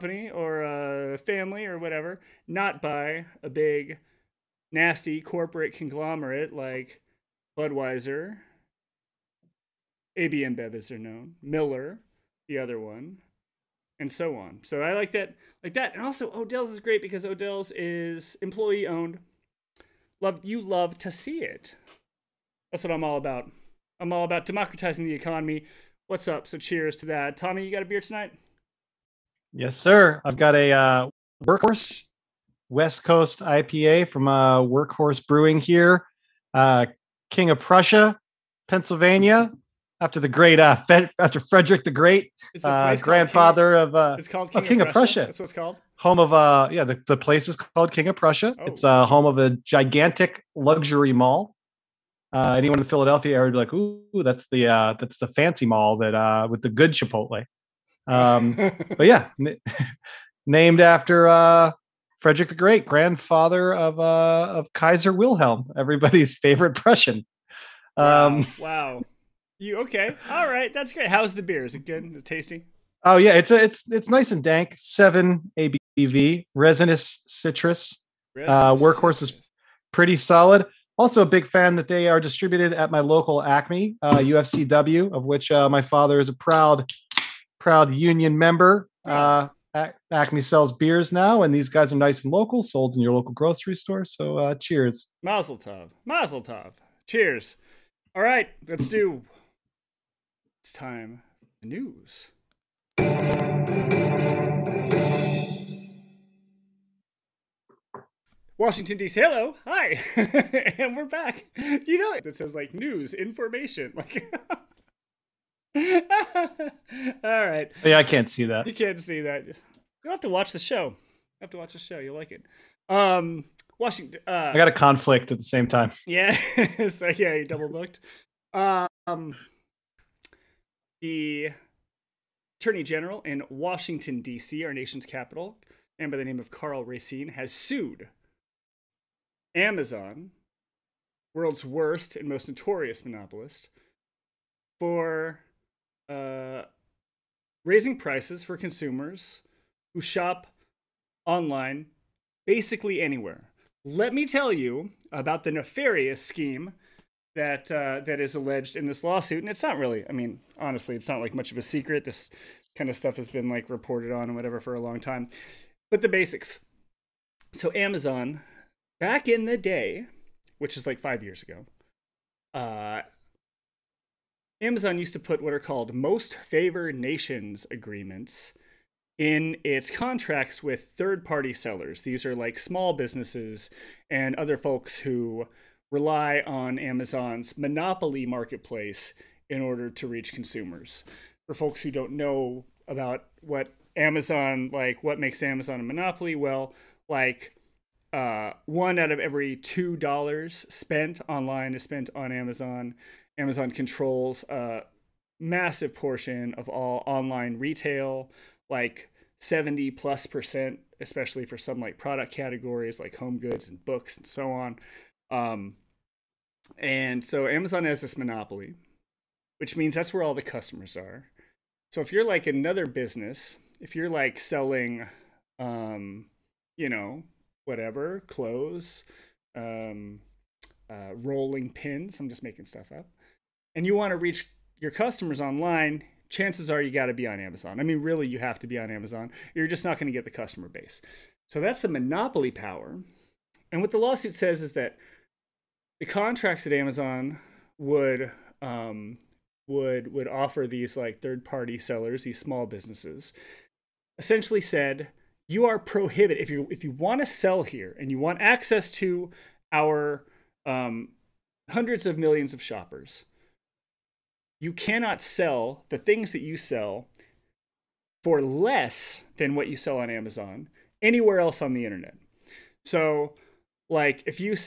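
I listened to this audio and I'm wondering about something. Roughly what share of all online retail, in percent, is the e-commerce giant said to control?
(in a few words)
70 percent.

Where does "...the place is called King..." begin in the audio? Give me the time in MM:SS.
00:47.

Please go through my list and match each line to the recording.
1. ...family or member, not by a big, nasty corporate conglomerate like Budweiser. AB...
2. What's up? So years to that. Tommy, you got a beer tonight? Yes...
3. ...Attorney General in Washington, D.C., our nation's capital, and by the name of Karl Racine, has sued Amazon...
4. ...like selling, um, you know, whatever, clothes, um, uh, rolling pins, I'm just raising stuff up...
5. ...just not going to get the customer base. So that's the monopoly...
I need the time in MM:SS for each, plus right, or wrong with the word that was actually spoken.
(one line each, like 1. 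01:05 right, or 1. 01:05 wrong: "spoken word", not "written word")
1. 00:01 wrong: "whatever", not "member"
2. 00:26 wrong: "cheers", not "years"
3. 02:12 right
4. 03:44 wrong: "making", not "raising"
5. 03:59 right.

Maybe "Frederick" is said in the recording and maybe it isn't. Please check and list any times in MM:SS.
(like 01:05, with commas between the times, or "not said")
00:41, 01:02.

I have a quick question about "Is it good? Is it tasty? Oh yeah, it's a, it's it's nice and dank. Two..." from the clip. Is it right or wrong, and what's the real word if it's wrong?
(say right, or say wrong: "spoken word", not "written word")
wrong: "Seven", not "Two".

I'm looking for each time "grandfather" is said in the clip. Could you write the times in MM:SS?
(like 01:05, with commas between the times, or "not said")
00:42, 01:02.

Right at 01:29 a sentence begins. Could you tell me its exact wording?
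Uh, Acme sells beers now, and these guys are nice and local, sold in your local grocery store.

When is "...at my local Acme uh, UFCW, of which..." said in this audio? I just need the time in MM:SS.
01:22.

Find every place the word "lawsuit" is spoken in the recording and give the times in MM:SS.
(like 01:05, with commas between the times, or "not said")
02:39, 04:03.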